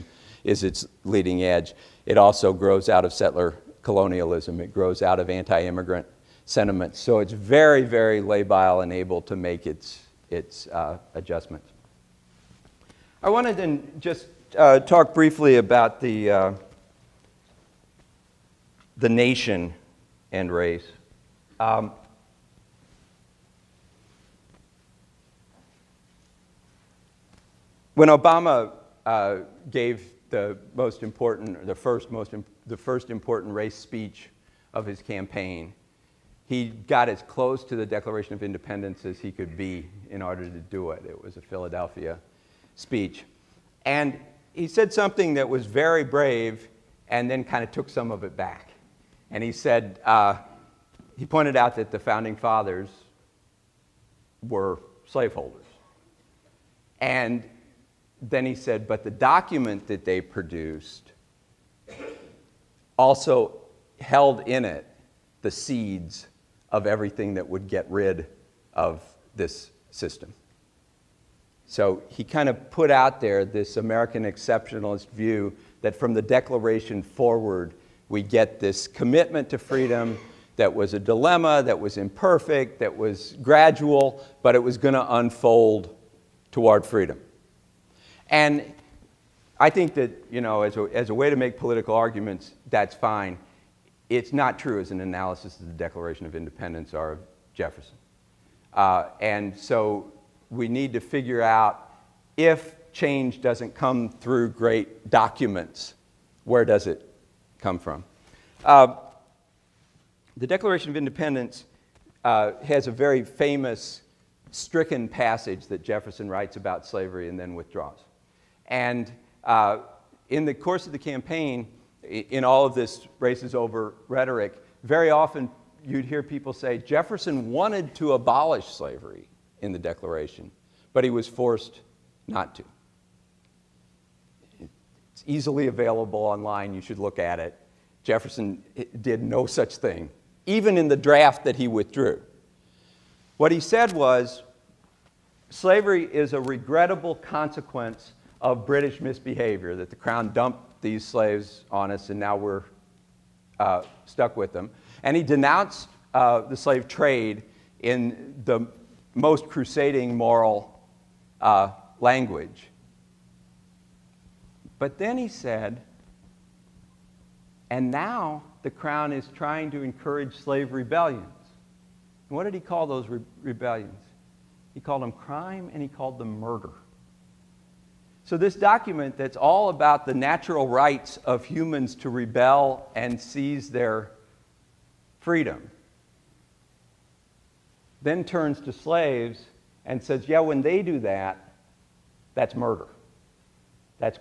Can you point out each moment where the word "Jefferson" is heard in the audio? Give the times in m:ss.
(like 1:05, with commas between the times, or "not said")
1:37, 1:55, 2:06, 2:18.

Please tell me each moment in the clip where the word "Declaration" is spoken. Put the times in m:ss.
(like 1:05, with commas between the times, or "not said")
0:37, 1:16, 1:35, 1:50, 2:09.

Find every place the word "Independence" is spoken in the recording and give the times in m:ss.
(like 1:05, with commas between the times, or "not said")
0:38, 1:36, 1:50.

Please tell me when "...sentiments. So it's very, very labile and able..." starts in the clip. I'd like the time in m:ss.
0:06.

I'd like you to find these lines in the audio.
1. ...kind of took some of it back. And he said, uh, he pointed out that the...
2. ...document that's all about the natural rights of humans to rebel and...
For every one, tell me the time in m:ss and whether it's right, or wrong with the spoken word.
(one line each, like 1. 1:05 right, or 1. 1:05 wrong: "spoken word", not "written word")
1. 0:47 right
2. 2:58 right.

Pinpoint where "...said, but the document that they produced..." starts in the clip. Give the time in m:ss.
0:58.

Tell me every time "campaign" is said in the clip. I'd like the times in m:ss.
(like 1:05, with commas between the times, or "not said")
0:35, 2:00.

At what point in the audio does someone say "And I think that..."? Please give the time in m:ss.
1:28.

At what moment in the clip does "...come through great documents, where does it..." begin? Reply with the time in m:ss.
1:43.